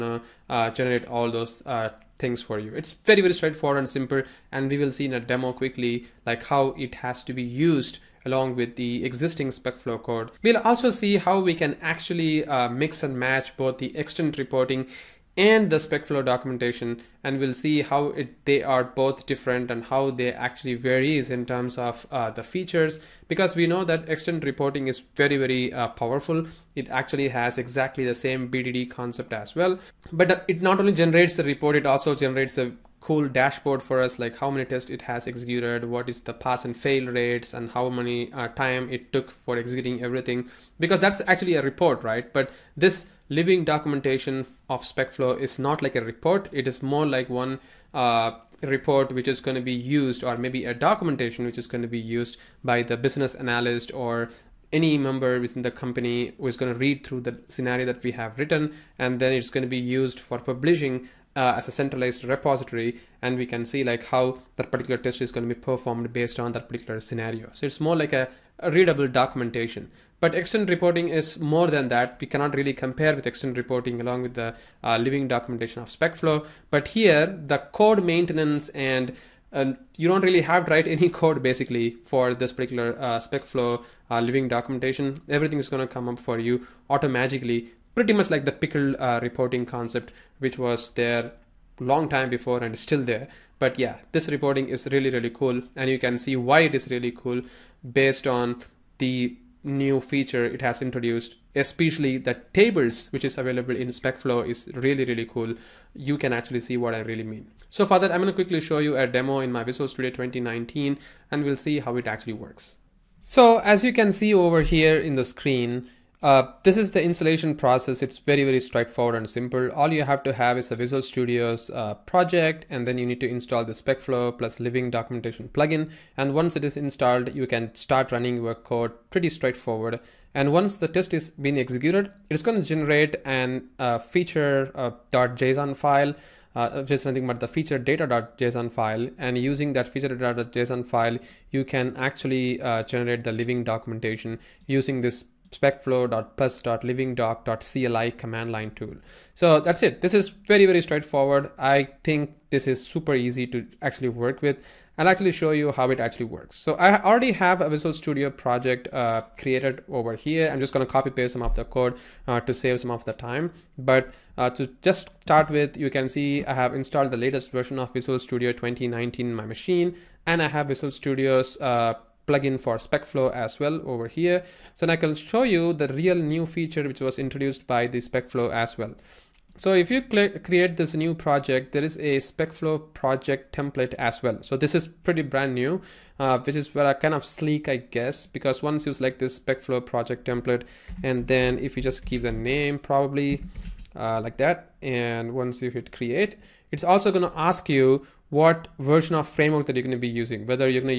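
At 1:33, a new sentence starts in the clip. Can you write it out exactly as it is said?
But yeah, this reporting is really, really cool.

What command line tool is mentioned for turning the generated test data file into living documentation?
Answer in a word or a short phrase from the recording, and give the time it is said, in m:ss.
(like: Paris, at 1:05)
specflow.plus.livingdoc.cli, at 2:25.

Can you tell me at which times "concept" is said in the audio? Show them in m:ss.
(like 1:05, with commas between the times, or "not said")
0:28, 1:29.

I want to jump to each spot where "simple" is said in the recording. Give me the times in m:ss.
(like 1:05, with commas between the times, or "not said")
0:03, 1:59.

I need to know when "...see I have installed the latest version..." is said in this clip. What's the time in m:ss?
2:46.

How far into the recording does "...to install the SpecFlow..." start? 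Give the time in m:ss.
2:03.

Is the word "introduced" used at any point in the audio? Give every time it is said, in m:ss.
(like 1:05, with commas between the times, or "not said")
1:40, 2:57.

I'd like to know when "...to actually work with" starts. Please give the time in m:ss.
2:33.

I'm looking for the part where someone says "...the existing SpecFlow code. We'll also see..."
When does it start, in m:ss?
0:08.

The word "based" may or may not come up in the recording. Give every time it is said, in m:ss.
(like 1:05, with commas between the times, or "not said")
1:06, 1:37.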